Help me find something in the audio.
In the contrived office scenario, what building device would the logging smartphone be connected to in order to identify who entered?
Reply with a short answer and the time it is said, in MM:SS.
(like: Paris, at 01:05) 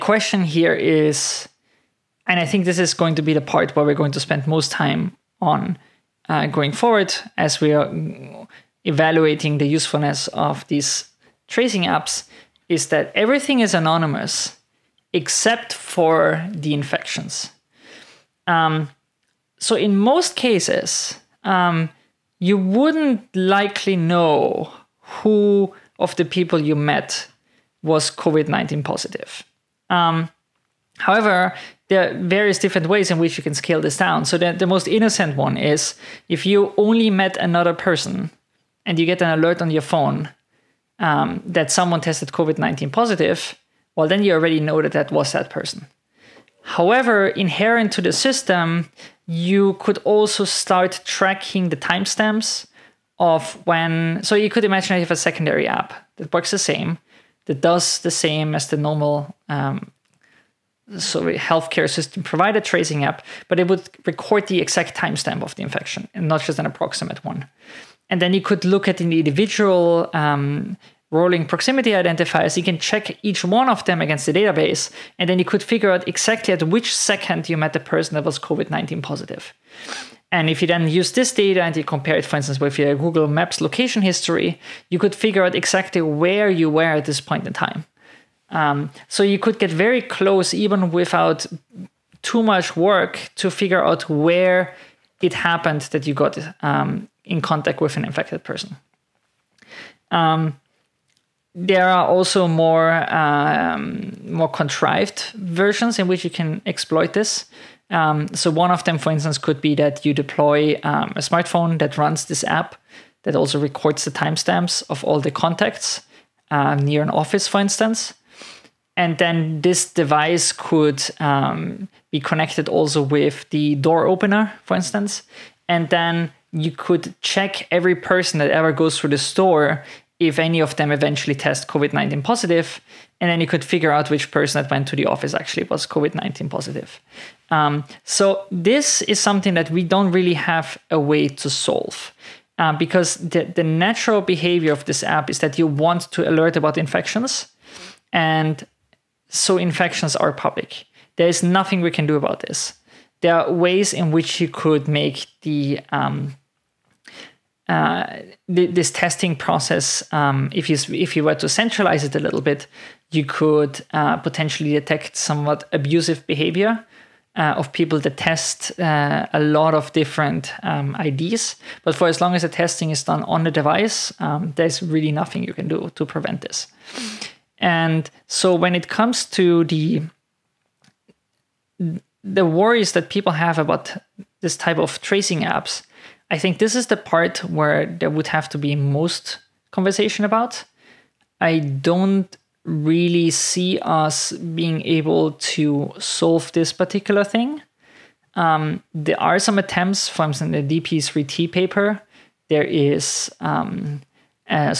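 door opener, at 02:03.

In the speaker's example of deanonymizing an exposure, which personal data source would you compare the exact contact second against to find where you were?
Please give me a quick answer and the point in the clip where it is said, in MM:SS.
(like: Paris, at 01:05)
Google Maps location history, at 01:22.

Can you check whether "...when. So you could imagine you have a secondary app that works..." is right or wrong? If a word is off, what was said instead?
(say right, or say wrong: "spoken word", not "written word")
right.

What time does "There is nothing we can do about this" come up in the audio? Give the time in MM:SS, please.
02:31.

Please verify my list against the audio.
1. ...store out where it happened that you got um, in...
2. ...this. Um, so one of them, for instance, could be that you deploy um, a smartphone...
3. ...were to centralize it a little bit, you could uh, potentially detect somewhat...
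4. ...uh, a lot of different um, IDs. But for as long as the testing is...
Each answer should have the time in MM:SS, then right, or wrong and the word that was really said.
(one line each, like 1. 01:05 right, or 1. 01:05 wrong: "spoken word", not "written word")
1. 01:33 wrong: "figure", not "store"
2. 01:47 right
3. 02:41 right
4. 02:48 right.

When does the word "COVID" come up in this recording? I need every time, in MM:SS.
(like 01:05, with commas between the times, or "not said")
00:28, 00:42, 01:18, 02:11, 02:15.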